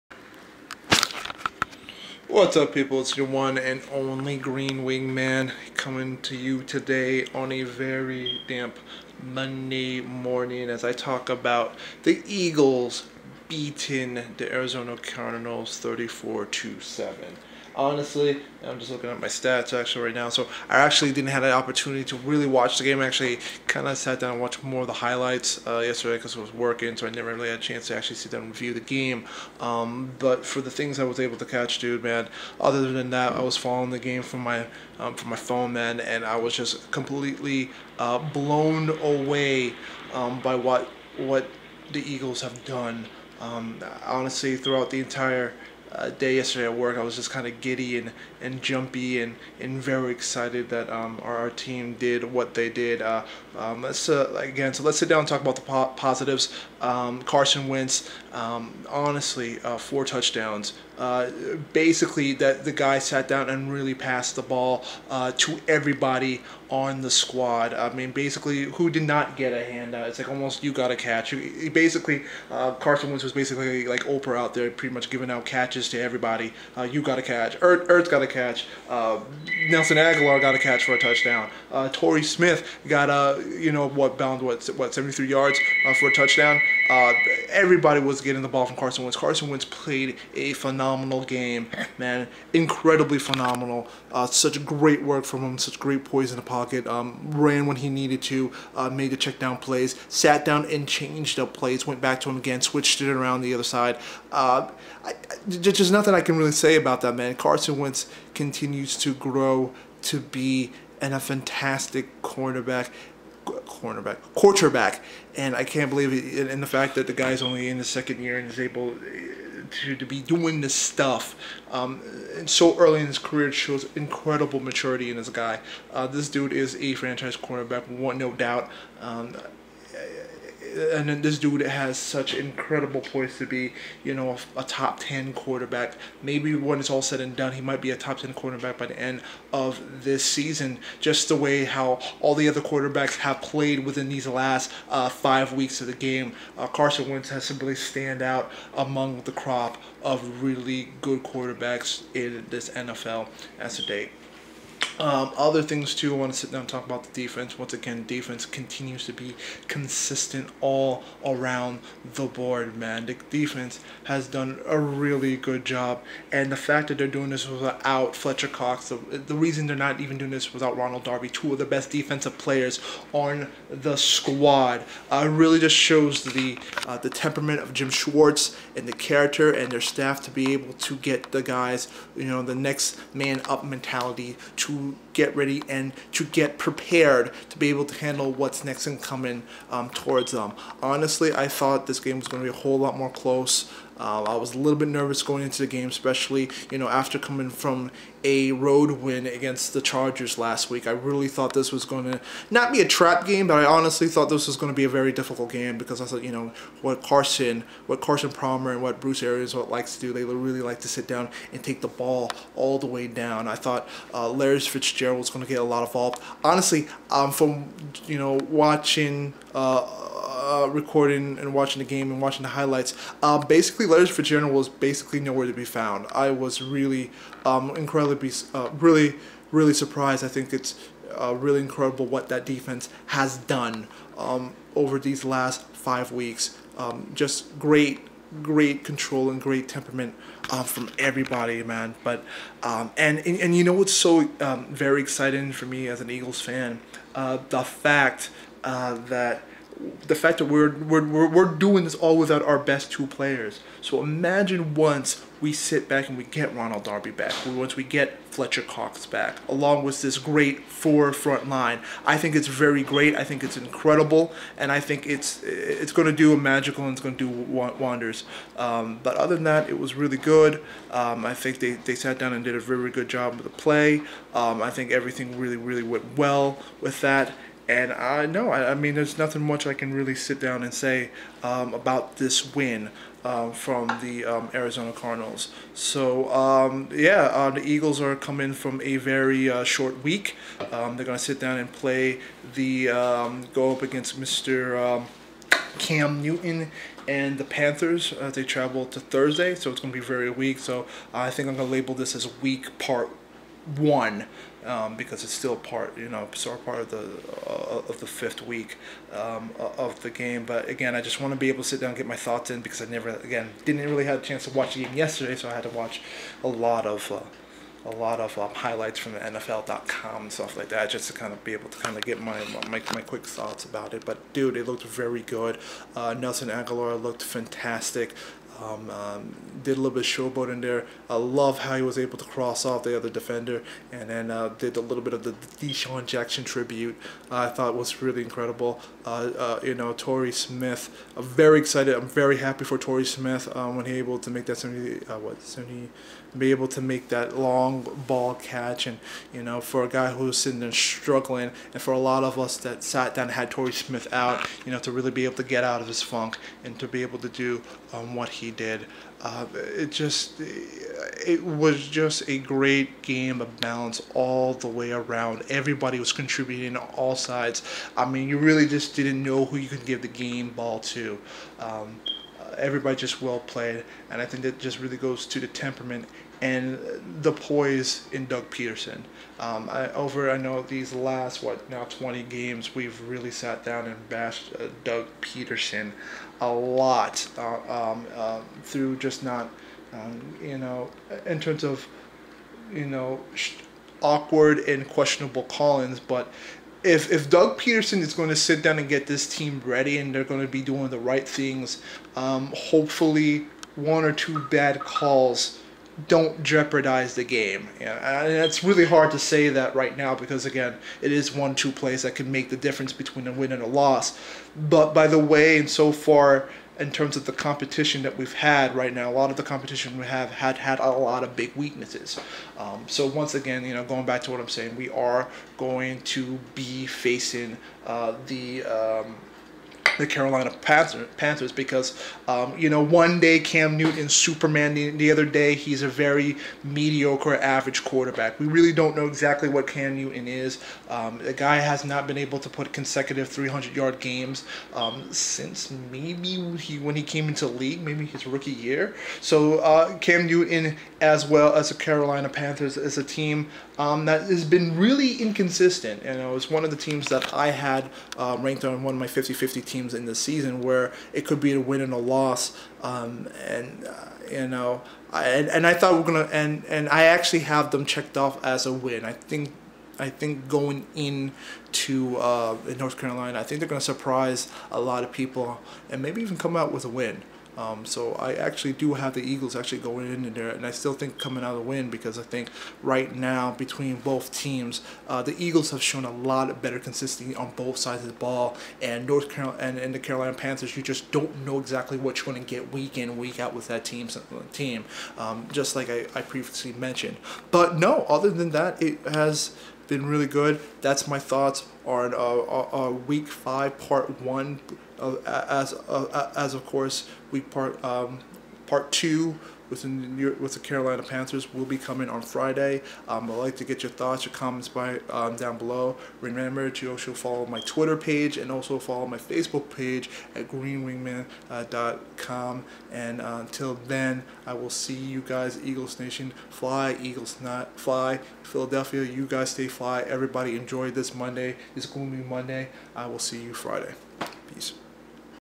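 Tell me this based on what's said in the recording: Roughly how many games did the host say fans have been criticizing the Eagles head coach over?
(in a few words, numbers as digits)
20.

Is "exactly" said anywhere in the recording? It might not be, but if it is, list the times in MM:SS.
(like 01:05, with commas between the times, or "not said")
07:19, 08:11.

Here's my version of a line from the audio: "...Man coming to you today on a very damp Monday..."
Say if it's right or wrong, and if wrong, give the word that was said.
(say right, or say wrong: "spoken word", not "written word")
right.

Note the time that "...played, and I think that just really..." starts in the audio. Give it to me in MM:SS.
06:13.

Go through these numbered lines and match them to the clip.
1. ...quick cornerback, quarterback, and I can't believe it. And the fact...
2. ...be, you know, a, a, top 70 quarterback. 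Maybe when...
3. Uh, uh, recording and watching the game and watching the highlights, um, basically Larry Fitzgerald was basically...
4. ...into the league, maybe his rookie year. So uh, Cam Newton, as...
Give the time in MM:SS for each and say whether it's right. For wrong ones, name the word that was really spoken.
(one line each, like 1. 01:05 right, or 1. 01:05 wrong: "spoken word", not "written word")
1. 01:52 wrong: "cornerback", not "quick"
2. 02:13 wrong: "10", not "70"
3. 03:39 right
4. 07:27 right.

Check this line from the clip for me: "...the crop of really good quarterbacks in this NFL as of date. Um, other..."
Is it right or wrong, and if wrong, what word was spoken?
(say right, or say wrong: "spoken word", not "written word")
right.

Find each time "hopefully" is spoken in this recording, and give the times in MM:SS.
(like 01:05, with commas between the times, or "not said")
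06:42.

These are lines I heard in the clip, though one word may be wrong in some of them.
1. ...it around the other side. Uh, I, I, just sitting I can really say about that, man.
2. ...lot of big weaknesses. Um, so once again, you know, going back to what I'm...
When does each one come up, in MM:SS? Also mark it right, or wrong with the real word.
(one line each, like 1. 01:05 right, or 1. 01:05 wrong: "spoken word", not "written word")
1. 01:42 wrong: "nothing", not "sitting"
2. 07:00 right.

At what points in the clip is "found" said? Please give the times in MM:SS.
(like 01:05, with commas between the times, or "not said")
03:45.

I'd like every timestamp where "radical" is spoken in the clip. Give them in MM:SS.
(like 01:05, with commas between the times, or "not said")
not said.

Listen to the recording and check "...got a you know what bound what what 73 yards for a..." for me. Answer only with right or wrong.
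right.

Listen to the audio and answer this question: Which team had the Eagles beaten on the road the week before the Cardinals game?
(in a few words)
Chargers.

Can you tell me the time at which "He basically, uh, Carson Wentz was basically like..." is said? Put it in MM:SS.
01:11.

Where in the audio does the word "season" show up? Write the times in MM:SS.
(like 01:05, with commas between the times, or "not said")
02:20, 07:40.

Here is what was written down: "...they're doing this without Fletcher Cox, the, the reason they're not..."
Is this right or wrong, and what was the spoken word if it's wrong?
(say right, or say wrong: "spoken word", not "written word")
right.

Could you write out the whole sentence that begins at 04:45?
So, um, yeah, uh, the Eagles are coming from a very uh, short week.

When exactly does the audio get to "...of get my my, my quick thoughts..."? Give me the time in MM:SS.
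05:21.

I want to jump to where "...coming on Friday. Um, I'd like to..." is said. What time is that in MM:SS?
08:31.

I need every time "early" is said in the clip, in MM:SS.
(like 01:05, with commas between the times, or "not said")
02:02.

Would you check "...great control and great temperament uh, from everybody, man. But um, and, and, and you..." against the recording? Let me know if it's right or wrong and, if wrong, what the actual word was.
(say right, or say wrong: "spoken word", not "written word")
right.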